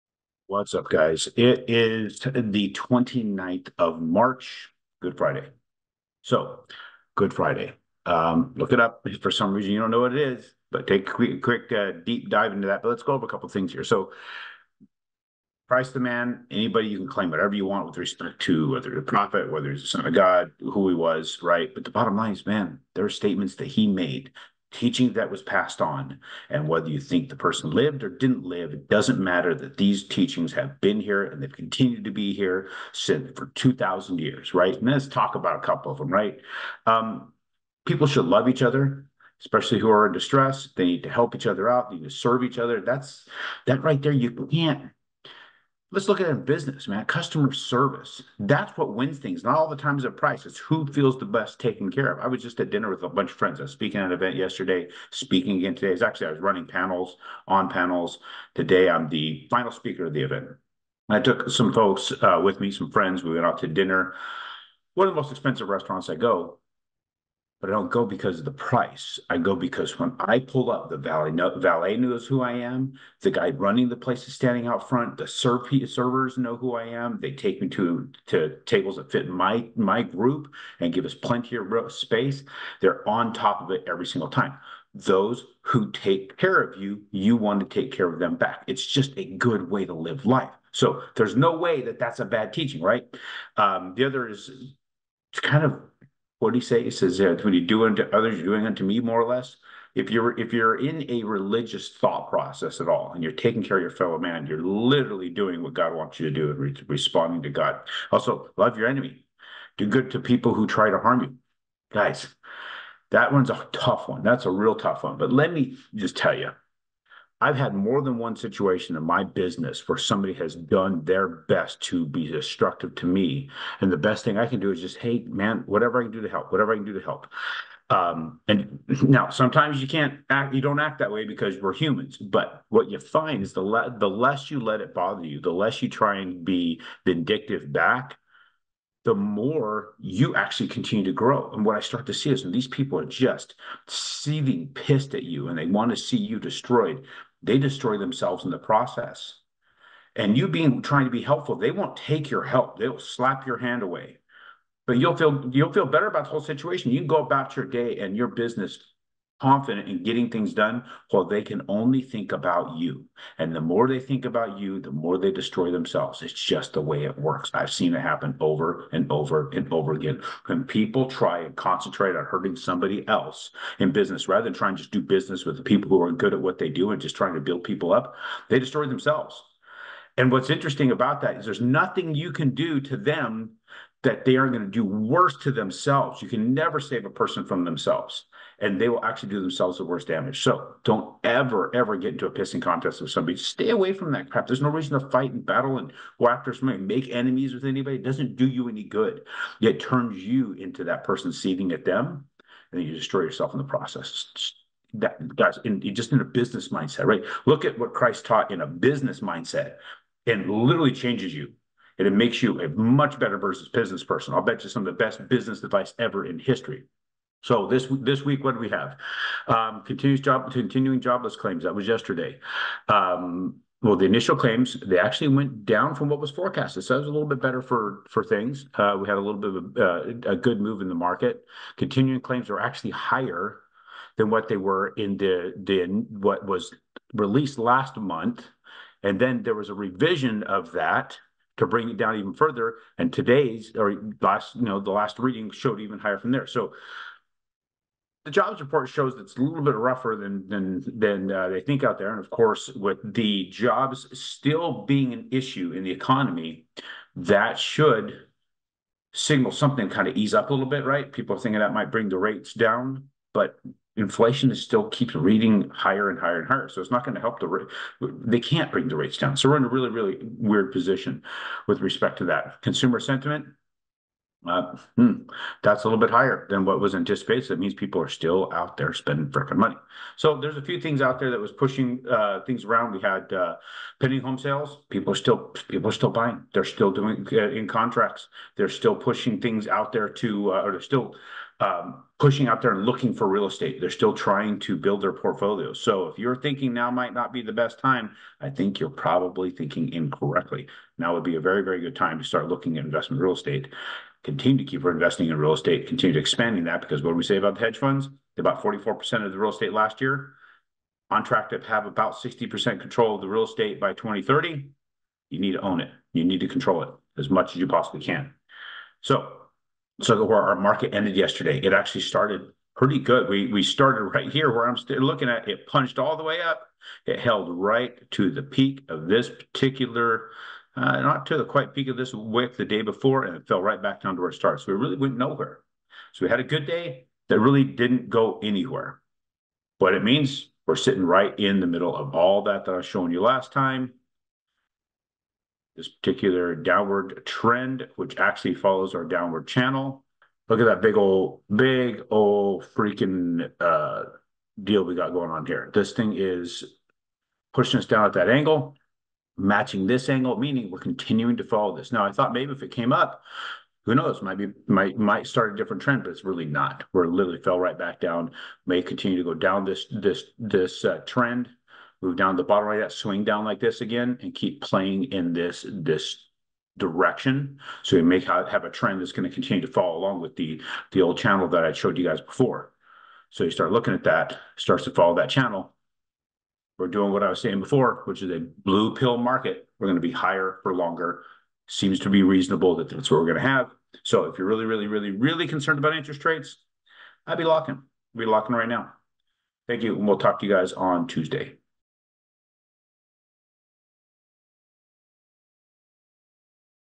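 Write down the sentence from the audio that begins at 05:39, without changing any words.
But it means we're sitting right in the middle of all that that I was showing you last time.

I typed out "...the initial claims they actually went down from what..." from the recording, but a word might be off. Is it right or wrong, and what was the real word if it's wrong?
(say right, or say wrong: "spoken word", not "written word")
right.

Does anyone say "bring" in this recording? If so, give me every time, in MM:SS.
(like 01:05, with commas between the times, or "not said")
04:01, 04:21, 04:28.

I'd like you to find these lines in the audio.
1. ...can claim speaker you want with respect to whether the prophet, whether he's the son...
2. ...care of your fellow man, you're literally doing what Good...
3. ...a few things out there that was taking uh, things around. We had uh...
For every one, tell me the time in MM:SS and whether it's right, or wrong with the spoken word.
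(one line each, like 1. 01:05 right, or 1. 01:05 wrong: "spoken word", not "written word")
1. 00:16 wrong: "whatever", not "speaker"
2. 01:43 wrong: "God", not "Good"
3. 04:40 wrong: "pushing", not "taking".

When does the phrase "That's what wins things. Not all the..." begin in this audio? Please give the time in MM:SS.
00:48.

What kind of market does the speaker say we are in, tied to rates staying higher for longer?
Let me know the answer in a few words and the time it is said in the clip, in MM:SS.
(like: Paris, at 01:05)
blue pill market, at 06:28.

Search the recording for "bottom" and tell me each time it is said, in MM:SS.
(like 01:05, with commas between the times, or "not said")
00:21, 06:12.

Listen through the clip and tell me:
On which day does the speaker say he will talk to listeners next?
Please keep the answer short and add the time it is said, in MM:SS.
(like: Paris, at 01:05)
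Tuesday, at 06:41.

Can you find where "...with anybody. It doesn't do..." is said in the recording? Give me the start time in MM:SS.
03:17.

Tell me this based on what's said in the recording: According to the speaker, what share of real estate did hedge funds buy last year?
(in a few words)
44%.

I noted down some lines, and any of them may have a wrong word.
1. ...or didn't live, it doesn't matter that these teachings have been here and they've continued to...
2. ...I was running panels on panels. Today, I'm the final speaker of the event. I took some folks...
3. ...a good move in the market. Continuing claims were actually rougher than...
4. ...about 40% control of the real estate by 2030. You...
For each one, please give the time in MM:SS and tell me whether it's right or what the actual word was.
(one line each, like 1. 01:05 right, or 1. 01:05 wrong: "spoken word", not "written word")
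1. 00:28 right
2. 00:56 right
3. 03:50 wrong: "higher", not "rougher"
4. 05:11 wrong: "60", not "40".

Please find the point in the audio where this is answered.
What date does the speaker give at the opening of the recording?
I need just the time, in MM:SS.
00:02.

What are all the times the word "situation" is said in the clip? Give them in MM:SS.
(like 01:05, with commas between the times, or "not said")
01:58, 02:36.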